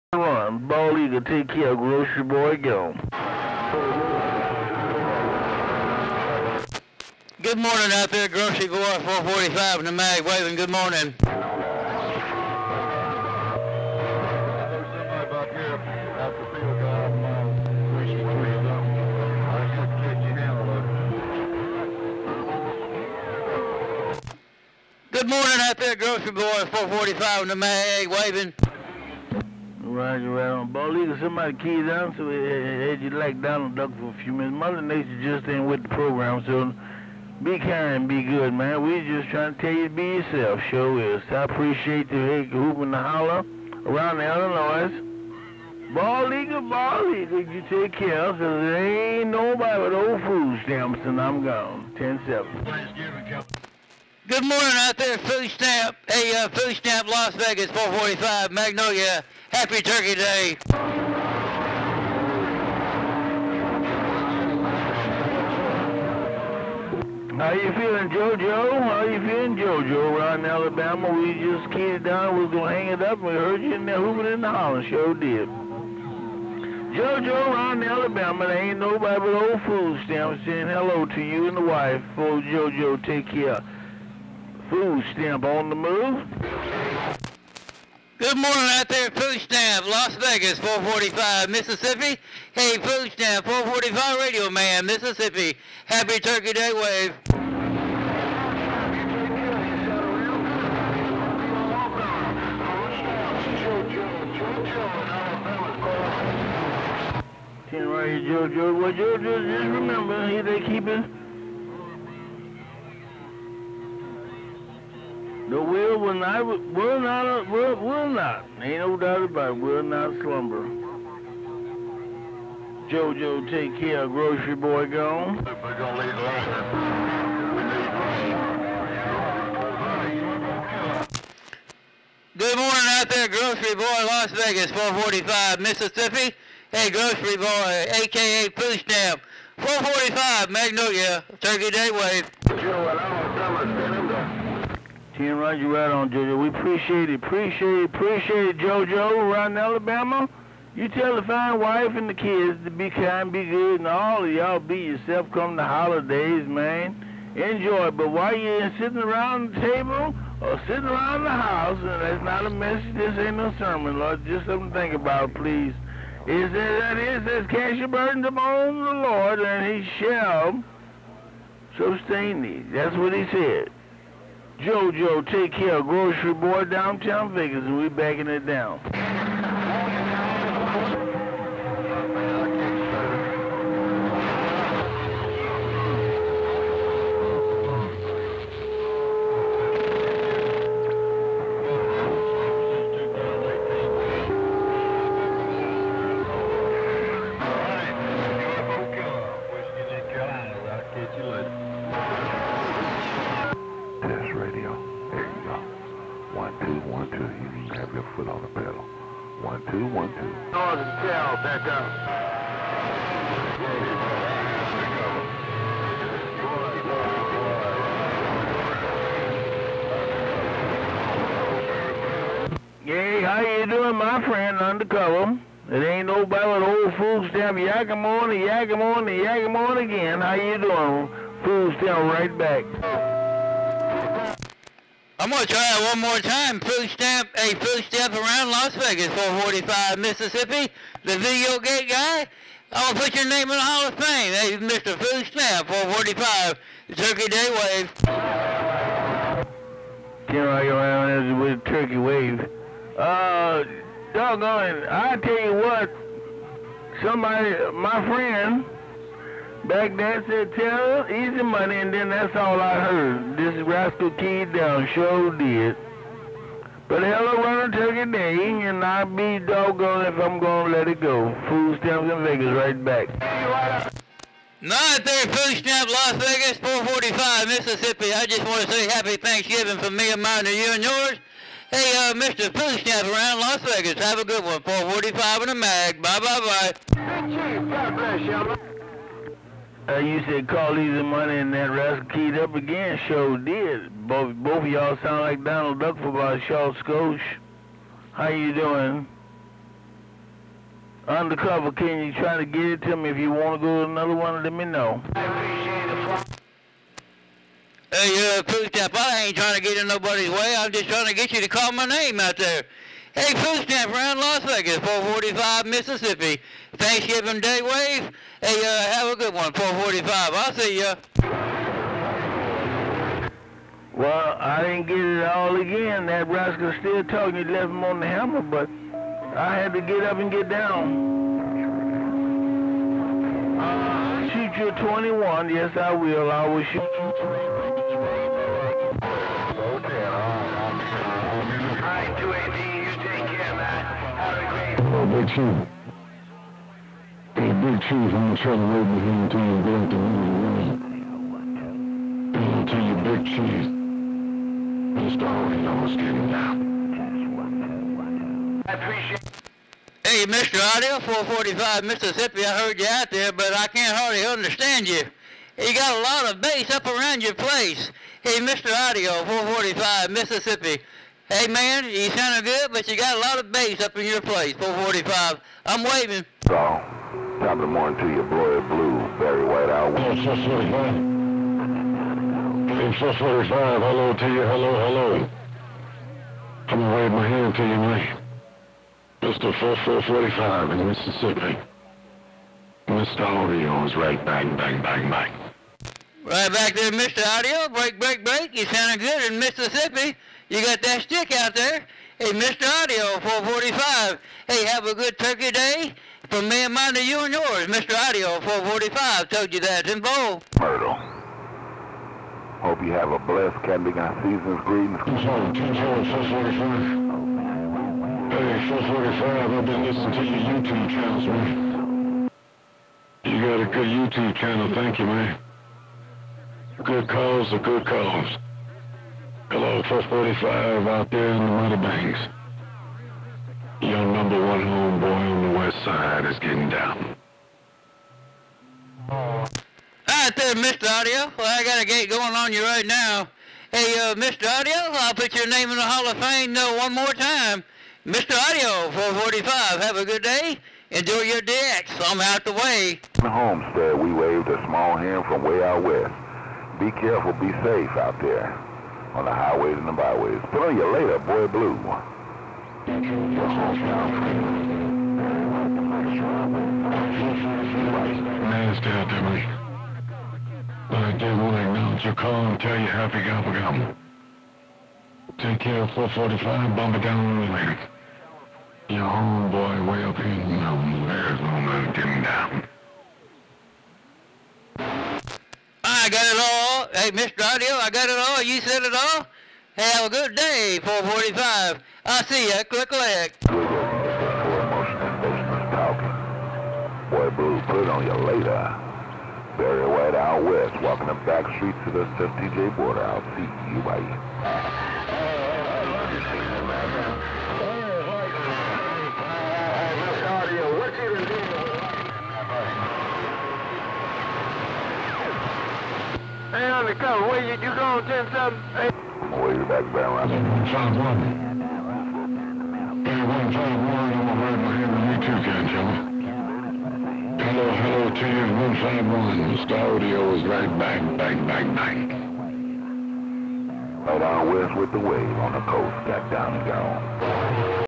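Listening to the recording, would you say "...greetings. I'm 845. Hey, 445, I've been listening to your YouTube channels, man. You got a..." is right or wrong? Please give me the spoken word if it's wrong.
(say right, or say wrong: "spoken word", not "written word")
wrong: "445", not "845".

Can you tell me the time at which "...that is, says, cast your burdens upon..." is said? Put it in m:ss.
2:46.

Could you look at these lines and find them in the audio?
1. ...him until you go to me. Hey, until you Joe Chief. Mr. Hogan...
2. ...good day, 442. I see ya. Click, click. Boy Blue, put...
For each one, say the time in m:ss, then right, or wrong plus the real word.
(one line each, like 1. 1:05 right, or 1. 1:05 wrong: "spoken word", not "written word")
1. 5:49 wrong: "Big", not "Joe"
2. 8:10 wrong: "445", not "442".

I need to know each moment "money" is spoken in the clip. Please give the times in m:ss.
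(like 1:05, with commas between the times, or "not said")
4:21, 4:51.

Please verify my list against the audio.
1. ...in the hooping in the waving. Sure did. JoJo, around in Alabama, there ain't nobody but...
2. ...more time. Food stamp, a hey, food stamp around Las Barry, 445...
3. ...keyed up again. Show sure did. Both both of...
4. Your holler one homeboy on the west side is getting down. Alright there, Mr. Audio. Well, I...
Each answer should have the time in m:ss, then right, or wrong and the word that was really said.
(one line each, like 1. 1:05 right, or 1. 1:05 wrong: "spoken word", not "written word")
1. 1:13 wrong: "hollering", not "waving"
2. 3:56 wrong: "Vegas", not "Barry"
3. 4:52 right
4. 7:13 wrong: "number", not "holler".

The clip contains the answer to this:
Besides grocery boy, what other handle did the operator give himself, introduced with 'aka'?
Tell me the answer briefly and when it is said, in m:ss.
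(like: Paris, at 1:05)
Pooch Dam, at 2:18.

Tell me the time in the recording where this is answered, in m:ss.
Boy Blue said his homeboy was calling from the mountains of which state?
8:01.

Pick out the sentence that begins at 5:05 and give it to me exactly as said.
Hey, uh, Food Stamp, I ain't trying to get in nobody's way.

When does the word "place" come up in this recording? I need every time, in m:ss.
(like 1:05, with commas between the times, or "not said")
6:07, 6:14.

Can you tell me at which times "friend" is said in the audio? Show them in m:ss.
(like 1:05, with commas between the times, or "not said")
3:44, 4:18.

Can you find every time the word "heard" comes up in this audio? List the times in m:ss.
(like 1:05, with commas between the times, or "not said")
1:13, 4:22, 6:02.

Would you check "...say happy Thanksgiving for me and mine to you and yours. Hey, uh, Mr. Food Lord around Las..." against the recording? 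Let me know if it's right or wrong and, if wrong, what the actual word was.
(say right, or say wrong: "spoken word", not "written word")
wrong: "Stamp", not "Lord".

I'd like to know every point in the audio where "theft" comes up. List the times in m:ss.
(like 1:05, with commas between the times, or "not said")
not said.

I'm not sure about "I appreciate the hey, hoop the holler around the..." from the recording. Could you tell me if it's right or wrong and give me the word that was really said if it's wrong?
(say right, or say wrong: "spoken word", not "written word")
right.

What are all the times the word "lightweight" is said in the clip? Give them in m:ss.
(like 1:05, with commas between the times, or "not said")
not said.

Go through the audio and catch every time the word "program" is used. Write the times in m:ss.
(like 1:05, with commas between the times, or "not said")
0:35.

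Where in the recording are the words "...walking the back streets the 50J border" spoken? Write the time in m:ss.
8:20.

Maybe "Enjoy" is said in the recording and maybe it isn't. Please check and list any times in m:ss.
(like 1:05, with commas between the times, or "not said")
2:37, 7:30.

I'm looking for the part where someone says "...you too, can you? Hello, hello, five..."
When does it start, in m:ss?
8:45.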